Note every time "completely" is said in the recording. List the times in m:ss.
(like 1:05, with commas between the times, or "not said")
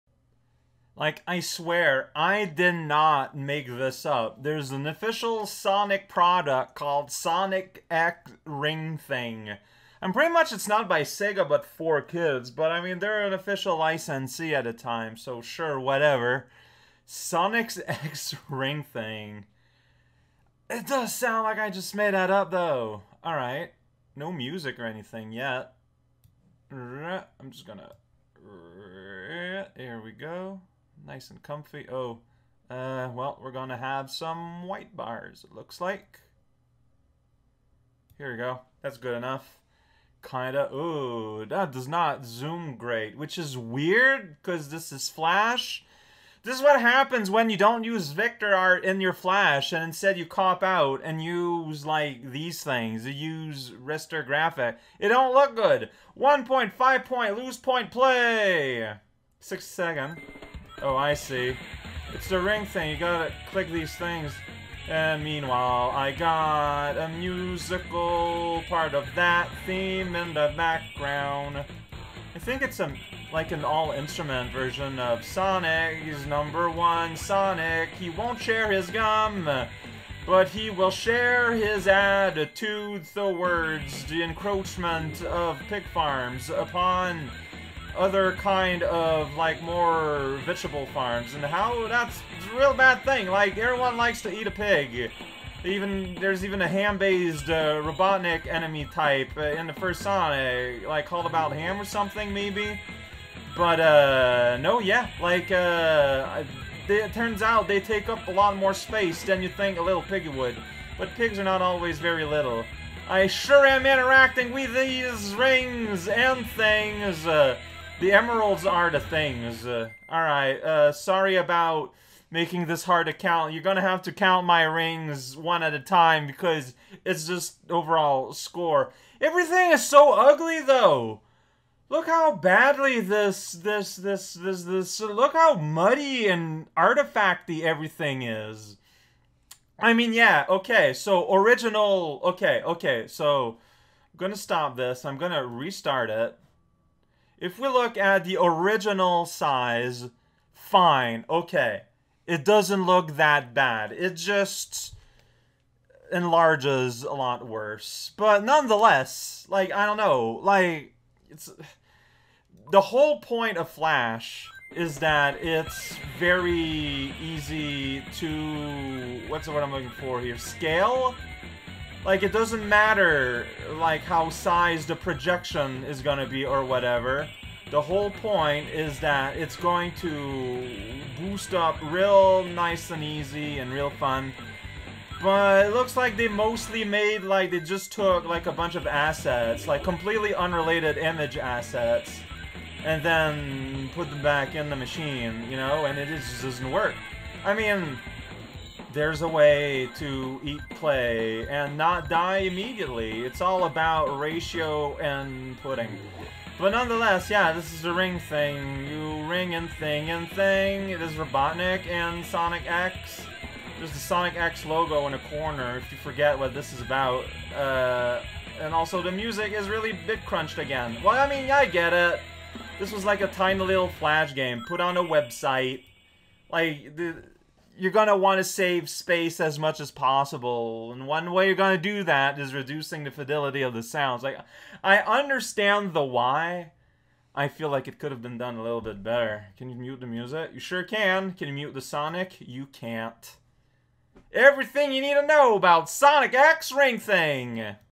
3:09.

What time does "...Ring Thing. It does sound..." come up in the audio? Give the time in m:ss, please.
0:18.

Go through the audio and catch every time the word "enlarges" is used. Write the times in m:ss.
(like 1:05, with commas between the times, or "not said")
2:36.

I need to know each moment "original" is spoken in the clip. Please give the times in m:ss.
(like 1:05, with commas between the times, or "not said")
2:21, 2:28.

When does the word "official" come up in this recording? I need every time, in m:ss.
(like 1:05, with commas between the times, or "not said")
0:04, 0:13.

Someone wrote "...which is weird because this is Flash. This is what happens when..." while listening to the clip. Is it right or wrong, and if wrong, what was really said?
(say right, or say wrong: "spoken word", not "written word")
right.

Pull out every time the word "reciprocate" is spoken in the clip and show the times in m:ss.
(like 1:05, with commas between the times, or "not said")
not said.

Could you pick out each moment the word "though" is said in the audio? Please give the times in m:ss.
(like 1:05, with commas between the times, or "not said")
0:22, 2:10.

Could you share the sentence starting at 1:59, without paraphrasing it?
Uh, Alright, uh, sorry about making this hard to count.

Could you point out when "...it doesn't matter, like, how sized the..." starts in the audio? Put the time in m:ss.
2:52.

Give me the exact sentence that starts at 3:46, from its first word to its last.
Like, the you're going to want to save space as much as possible.